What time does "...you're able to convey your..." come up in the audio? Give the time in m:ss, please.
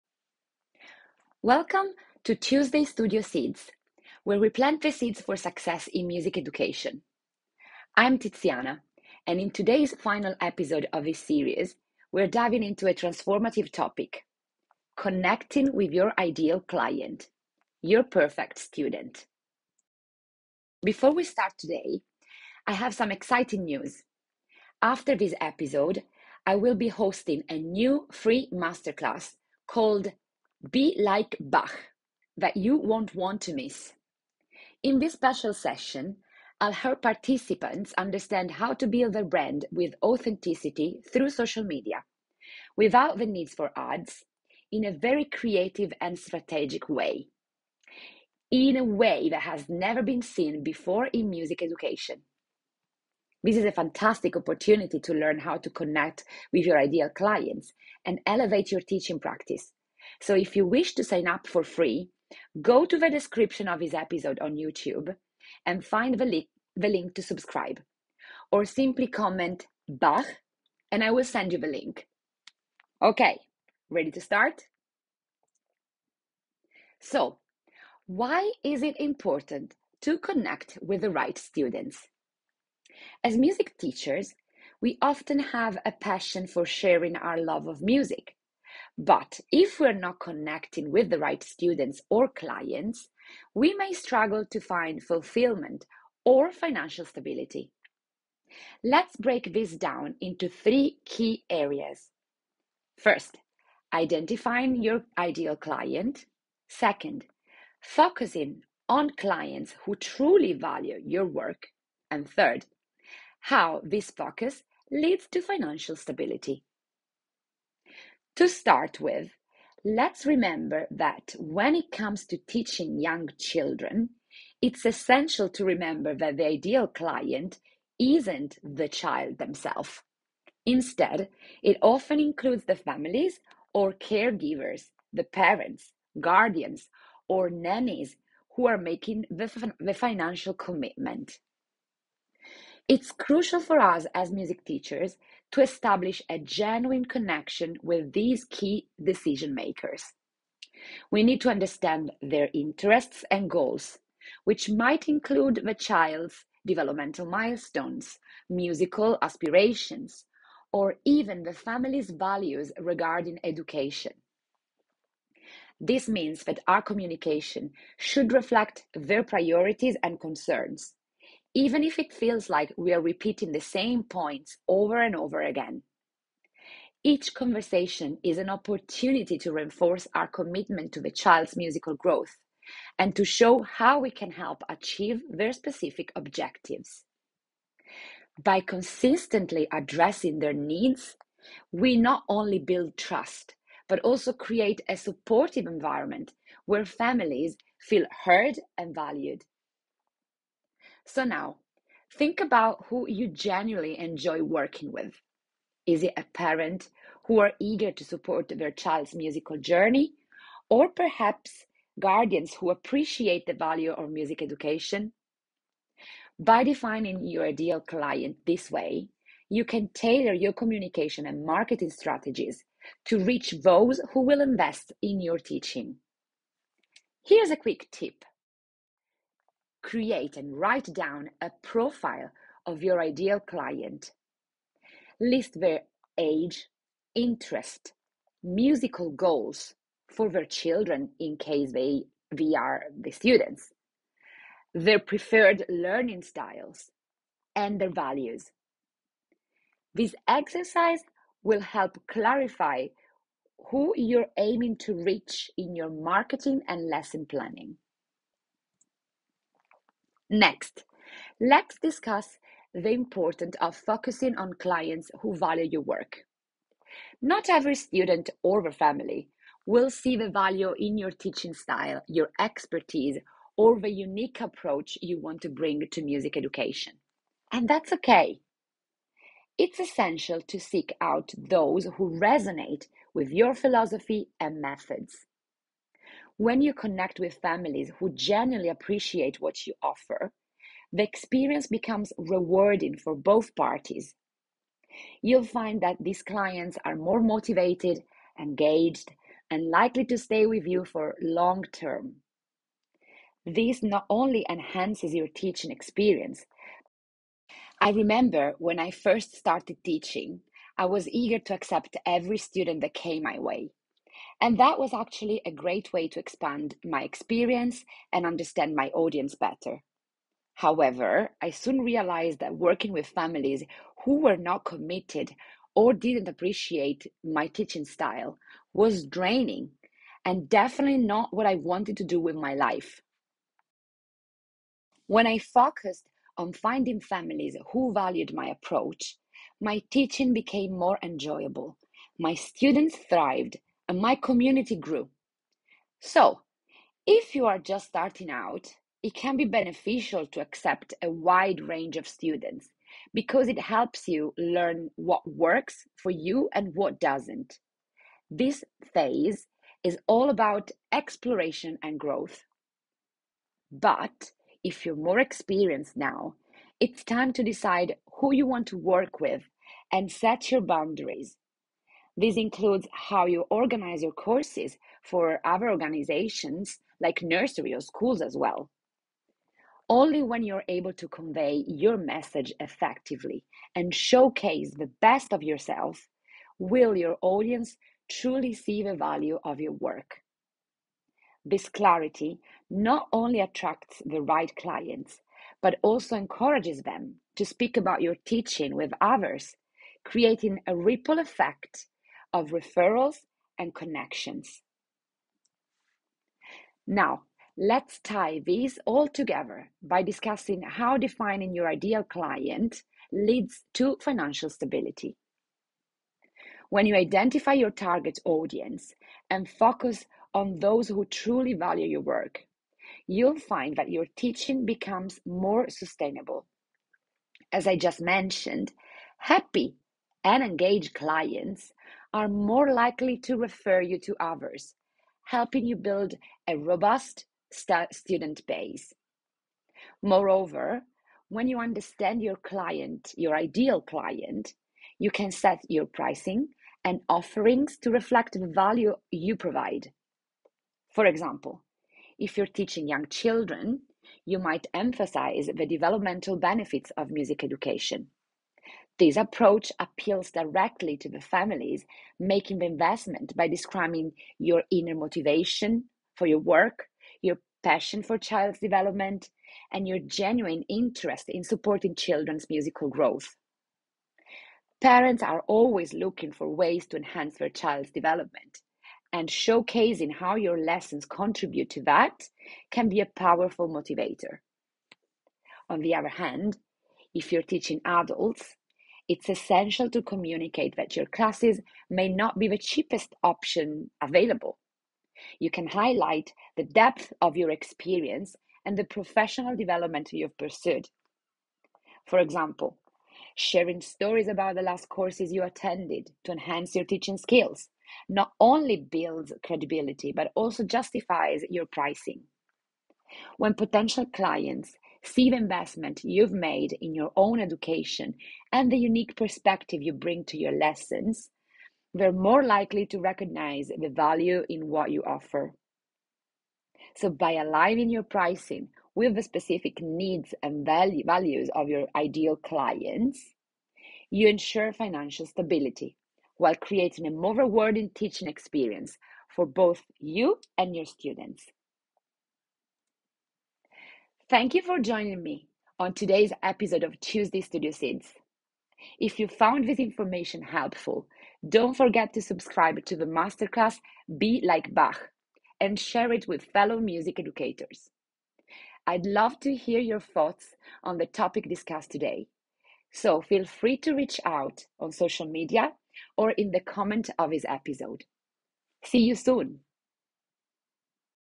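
6:20.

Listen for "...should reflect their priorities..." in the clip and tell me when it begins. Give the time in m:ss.
2:47.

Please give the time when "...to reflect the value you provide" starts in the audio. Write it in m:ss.
7:27.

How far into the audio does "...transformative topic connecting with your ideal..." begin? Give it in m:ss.
0:12.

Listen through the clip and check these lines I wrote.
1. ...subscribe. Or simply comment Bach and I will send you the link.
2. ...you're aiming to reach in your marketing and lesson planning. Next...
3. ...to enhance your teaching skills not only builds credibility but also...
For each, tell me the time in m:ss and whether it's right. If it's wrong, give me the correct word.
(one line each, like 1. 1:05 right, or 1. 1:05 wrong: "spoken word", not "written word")
1. 1:07 right
2. 4:13 right
3. 8:26 right.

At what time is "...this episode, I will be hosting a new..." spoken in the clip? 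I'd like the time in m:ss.
0:25.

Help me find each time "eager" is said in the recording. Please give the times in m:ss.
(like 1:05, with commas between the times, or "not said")
3:27, 5:11.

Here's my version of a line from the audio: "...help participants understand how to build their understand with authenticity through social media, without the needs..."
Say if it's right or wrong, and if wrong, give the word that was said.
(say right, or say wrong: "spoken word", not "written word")
wrong: "brand", not "understand".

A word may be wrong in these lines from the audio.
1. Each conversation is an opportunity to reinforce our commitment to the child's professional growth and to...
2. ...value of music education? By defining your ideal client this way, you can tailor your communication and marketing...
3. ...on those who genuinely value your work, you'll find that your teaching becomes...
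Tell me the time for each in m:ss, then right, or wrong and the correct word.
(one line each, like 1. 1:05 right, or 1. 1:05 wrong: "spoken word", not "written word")
1. 2:57 wrong: "musical", not "professional"
2. 3:33 right
3. 7:00 wrong: "truly", not "genuinely".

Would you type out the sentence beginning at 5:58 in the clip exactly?
This phase is all about exploration and growth.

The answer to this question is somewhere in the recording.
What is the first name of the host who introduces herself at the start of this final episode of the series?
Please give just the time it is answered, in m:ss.
0:08.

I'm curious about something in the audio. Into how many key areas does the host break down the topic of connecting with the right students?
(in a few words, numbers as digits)
3.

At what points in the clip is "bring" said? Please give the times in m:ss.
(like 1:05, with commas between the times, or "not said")
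4:35, 8:39.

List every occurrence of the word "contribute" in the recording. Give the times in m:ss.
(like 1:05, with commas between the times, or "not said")
8:01.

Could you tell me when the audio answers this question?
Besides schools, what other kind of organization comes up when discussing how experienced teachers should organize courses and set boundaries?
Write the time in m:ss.
6:17.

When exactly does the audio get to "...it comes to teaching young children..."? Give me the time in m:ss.
2:01.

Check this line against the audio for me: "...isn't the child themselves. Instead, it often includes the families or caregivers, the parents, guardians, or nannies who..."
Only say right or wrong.
right.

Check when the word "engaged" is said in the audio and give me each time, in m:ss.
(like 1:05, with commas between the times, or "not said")
4:58, 7:10.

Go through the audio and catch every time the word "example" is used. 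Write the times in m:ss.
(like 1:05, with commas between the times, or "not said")
7:31, 8:22.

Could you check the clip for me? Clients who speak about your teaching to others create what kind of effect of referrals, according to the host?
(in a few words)
ripple effect.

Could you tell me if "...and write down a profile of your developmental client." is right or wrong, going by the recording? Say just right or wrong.
wrong.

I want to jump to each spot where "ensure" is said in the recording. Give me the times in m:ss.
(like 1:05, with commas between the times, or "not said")
8:54.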